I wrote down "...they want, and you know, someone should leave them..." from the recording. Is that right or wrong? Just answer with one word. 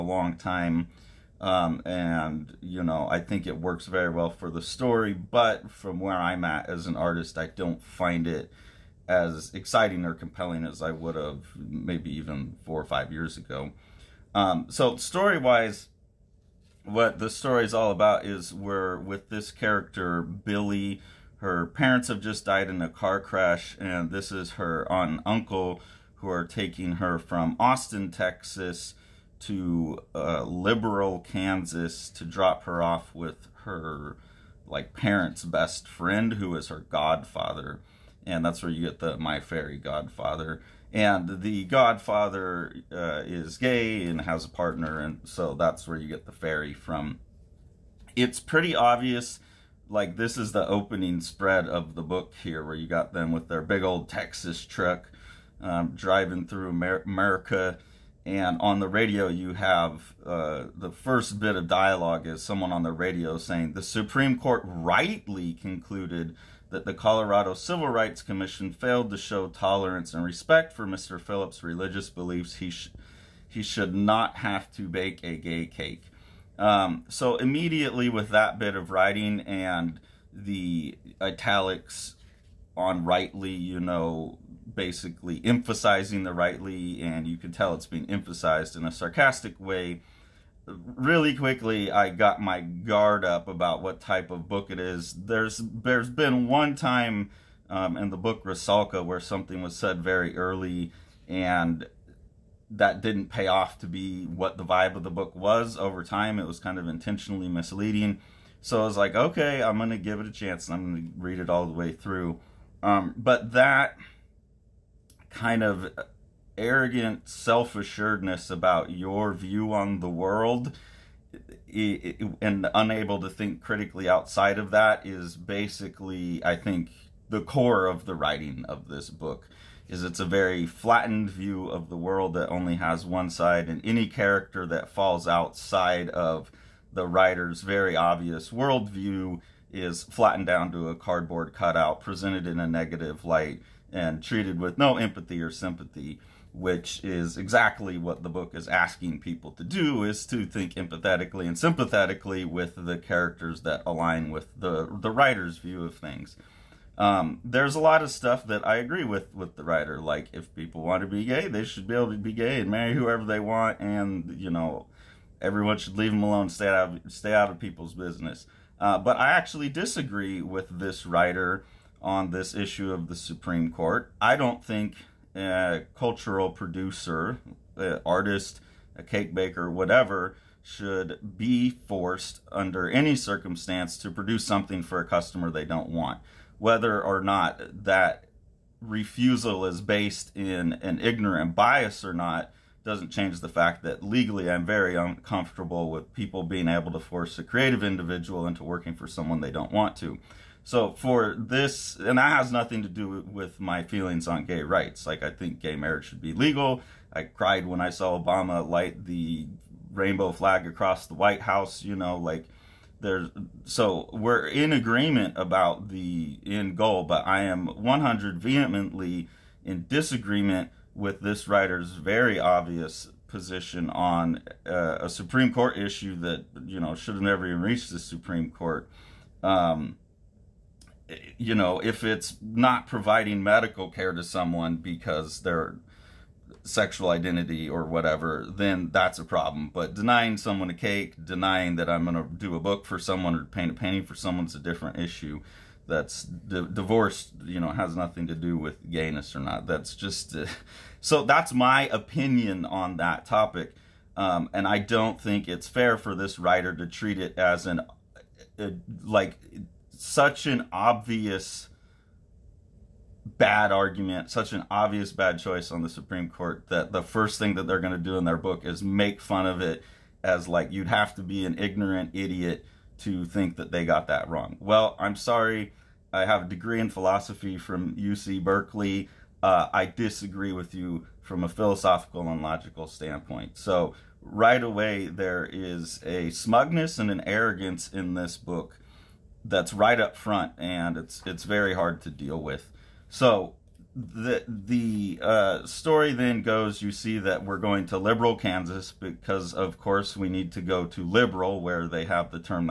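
wrong.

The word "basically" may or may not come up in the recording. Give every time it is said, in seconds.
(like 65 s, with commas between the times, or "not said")
84 s, 125 s.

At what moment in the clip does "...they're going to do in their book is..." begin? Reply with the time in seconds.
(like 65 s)
267 s.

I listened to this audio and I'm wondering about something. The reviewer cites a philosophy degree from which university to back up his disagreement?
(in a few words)
UC Berkeley.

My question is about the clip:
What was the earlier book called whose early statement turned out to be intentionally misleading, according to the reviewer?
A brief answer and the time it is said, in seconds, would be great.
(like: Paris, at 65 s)
Rasalka, at 98 s.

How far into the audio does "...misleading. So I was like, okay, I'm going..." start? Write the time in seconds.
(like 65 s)
107 s.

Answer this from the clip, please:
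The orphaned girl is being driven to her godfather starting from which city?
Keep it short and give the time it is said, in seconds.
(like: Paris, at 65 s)
Austin, Texas, at 27 s.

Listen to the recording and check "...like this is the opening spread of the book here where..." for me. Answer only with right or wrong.
right.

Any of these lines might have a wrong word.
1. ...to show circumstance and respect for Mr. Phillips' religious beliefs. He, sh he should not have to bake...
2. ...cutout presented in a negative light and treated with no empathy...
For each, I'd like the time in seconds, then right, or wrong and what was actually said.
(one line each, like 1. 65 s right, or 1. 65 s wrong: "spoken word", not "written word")
1. 69 s wrong: "tolerance", not "circumstance"
2. 141 s right.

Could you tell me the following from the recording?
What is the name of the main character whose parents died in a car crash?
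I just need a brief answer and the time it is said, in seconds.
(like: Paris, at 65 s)
Billy, at 20 s.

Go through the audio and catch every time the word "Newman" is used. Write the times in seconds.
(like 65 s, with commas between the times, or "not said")
not said.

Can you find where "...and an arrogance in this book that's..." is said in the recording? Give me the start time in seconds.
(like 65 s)
286 s.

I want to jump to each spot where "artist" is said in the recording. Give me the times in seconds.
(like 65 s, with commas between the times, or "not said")
6 s, 178 s.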